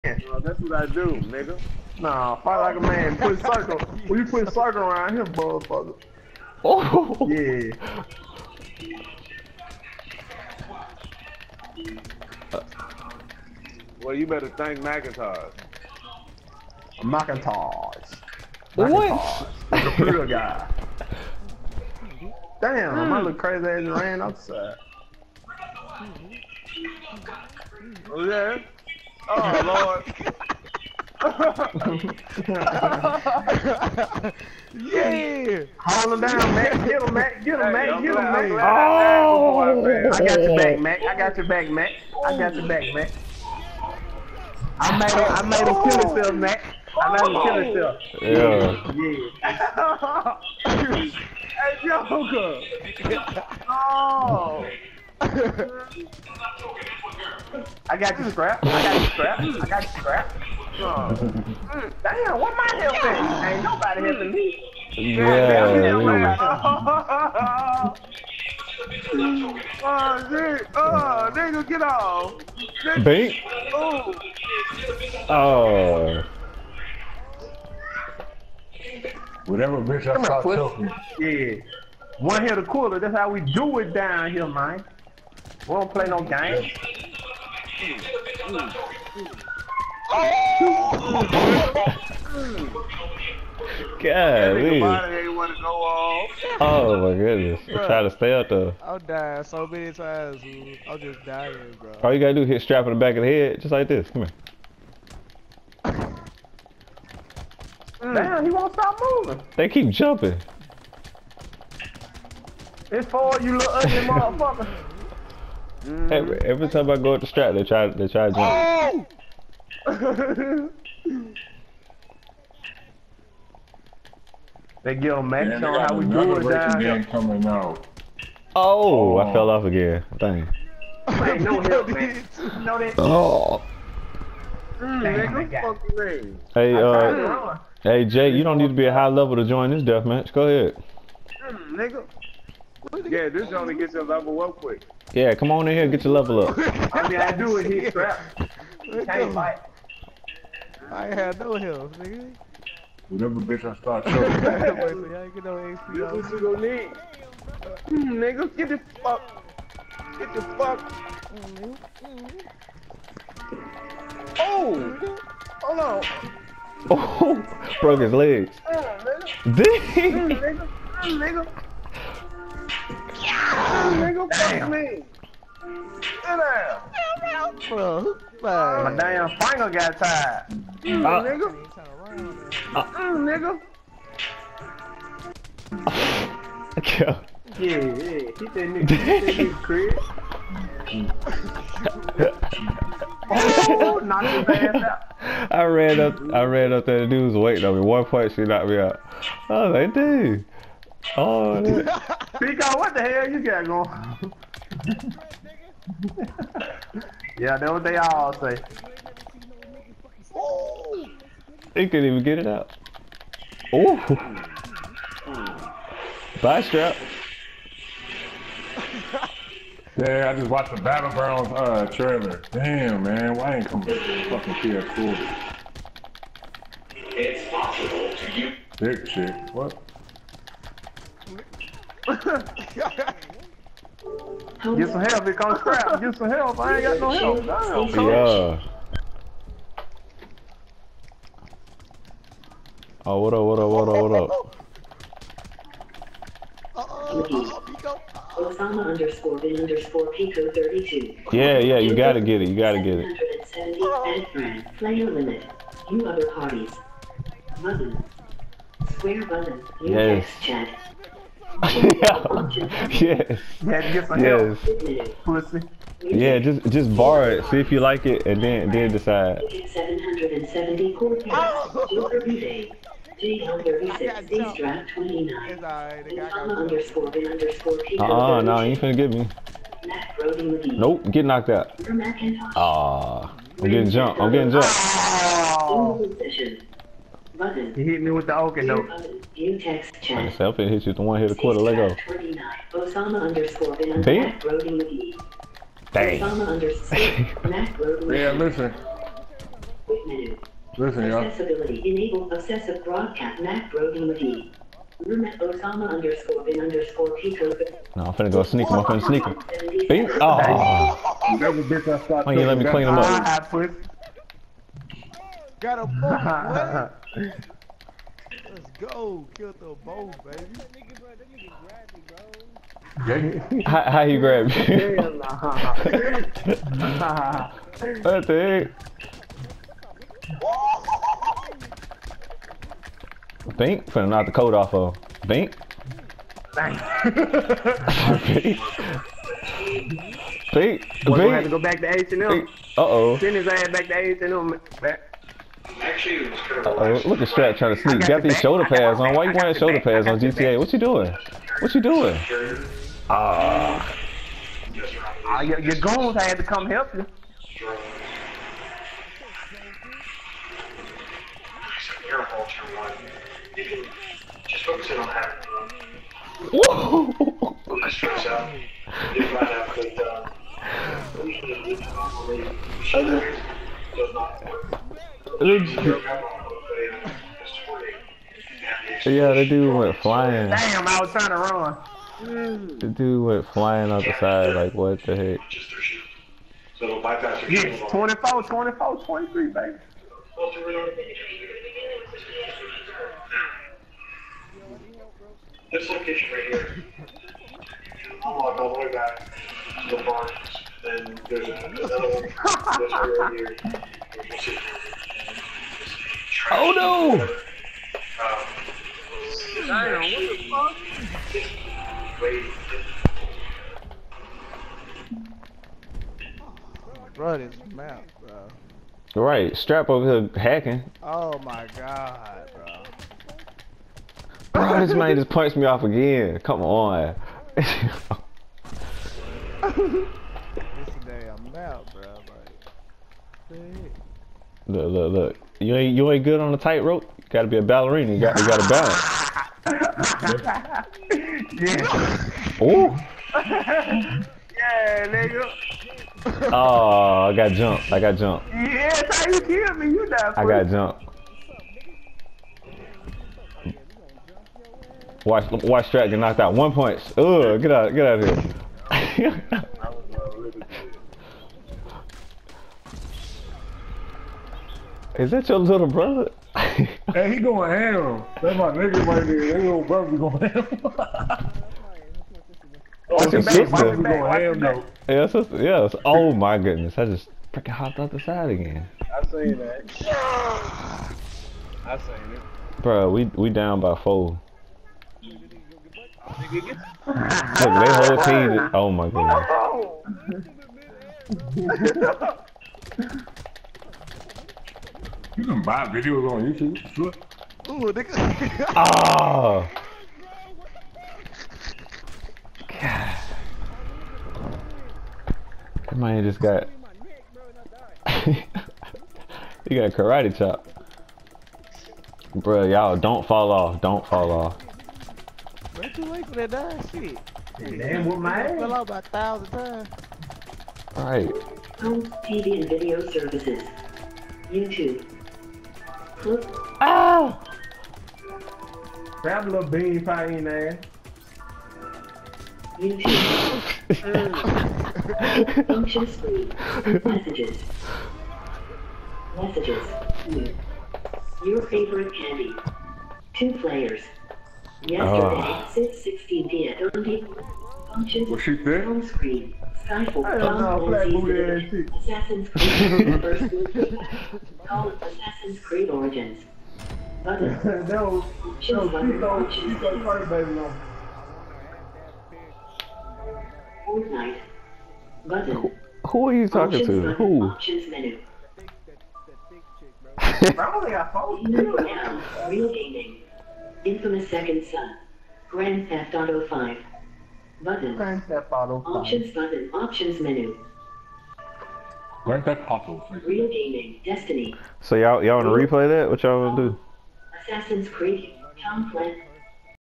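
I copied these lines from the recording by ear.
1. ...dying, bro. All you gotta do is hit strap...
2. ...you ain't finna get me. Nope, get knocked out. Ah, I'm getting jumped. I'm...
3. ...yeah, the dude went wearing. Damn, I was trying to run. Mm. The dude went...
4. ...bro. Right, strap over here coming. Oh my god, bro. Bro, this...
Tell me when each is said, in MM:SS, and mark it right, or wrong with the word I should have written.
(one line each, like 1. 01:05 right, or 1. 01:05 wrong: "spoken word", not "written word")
1. 01:41 right
2. 04:38 right
3. 06:19 wrong: "flying", not "wearing"
4. 06:58 wrong: "hacking", not "coming".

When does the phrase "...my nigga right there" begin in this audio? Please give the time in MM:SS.
07:48.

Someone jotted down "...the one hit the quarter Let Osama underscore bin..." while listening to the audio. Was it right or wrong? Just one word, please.
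right.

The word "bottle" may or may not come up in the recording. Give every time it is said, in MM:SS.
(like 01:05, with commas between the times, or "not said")
09:38, 09:42.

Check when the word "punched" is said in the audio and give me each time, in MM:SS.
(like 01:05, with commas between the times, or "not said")
07:05.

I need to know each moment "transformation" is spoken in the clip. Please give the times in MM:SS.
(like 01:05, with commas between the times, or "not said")
not said.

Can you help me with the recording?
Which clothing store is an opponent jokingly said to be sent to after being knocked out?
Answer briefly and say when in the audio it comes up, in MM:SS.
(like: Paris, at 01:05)
H&M, at 05:43.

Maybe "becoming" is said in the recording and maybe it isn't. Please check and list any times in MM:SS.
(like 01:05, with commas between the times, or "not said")
not said.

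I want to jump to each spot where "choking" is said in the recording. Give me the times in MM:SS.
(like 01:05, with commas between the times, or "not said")
01:20, 02:34.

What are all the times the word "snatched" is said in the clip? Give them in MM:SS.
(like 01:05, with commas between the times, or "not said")
not said.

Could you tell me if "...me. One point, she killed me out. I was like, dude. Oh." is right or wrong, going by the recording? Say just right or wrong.
wrong.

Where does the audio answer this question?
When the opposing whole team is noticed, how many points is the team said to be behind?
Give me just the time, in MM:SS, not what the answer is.
08:03.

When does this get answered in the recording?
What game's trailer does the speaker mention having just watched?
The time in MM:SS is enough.
03:40.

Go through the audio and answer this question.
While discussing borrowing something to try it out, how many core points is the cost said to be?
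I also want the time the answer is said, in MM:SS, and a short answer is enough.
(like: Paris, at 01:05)
770, at 04:29.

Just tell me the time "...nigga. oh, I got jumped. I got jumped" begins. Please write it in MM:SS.
07:25.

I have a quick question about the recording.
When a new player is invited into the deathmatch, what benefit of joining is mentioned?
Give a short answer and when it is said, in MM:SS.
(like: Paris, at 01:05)
Level up quick, at 02:24.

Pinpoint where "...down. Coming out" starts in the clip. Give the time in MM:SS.
02:06.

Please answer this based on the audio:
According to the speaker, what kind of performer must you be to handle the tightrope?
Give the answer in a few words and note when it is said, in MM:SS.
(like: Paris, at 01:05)
Ballerina, at 07:17.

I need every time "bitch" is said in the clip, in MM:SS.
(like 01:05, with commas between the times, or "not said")
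01:19, 02:33, 05:11.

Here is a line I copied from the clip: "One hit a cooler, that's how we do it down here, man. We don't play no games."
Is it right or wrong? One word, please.
right.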